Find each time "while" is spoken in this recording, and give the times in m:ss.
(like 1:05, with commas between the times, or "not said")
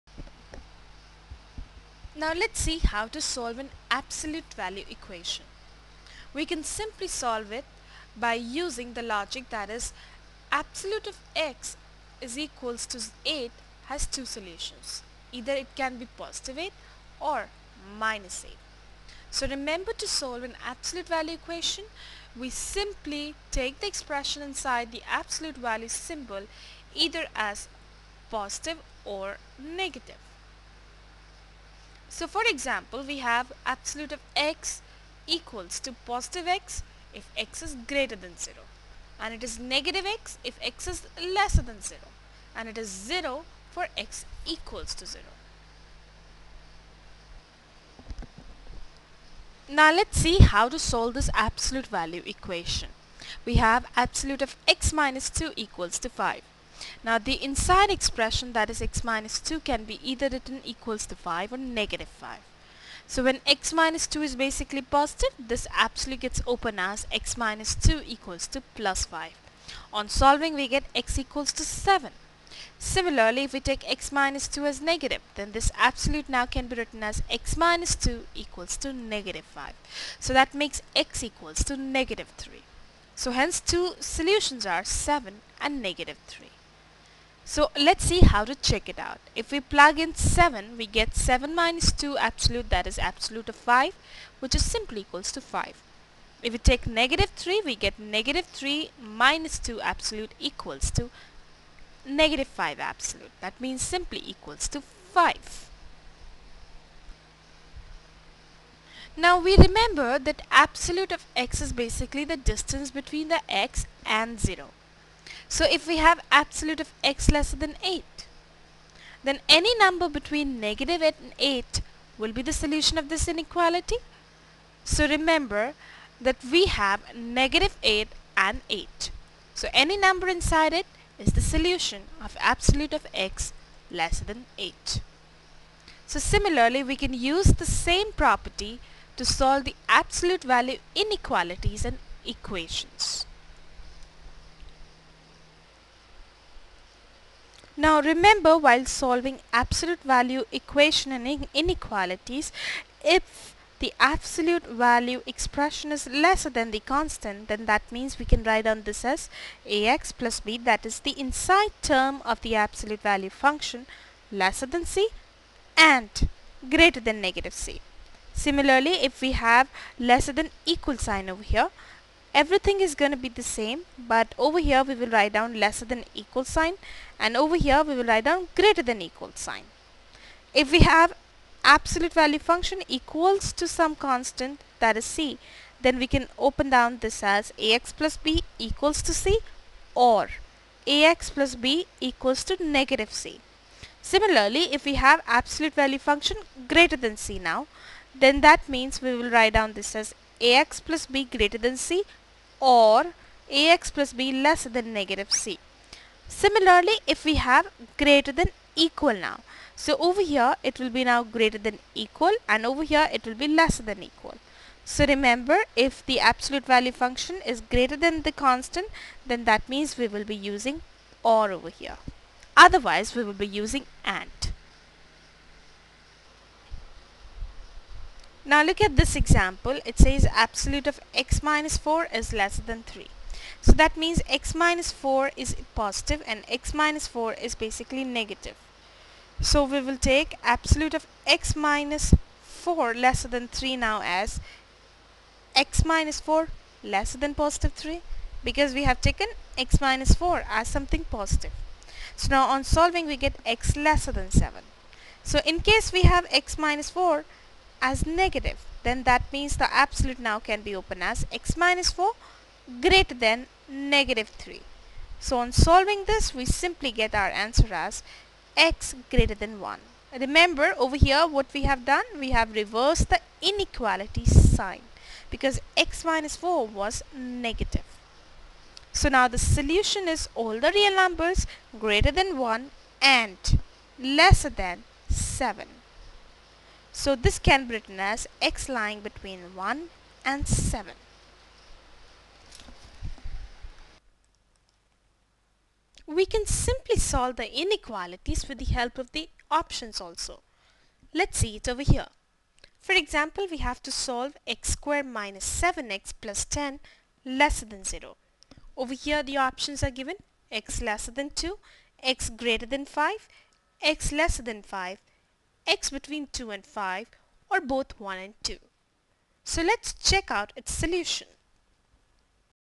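2:28.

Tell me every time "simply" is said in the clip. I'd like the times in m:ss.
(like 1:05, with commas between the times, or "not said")
0:06, 0:22, 1:34, 1:43, 4:26, 4:56.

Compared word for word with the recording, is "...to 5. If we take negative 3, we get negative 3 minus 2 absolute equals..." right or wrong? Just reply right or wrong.
right.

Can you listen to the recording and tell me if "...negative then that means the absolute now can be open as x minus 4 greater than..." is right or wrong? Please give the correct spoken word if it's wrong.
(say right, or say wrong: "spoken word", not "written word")
right.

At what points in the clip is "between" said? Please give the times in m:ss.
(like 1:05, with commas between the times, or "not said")
1:52, 2:00, 4:48, 5:15.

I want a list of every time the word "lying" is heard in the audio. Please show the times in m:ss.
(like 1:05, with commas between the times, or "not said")
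4:48.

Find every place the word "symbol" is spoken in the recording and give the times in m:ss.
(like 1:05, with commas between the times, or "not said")
0:25.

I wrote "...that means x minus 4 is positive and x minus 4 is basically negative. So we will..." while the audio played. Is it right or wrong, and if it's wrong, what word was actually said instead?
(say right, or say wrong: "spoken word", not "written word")
right.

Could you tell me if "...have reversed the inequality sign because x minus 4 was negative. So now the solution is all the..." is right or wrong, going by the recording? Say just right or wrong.
right.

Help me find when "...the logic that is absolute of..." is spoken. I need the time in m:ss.
0:08.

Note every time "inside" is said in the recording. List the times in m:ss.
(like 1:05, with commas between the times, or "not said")
0:24, 0:57, 2:10, 2:41.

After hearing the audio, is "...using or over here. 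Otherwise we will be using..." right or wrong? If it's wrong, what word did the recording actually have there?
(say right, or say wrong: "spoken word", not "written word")
right.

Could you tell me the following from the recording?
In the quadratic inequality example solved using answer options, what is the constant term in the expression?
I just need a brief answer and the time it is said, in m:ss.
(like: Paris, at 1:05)
10, at 5:06.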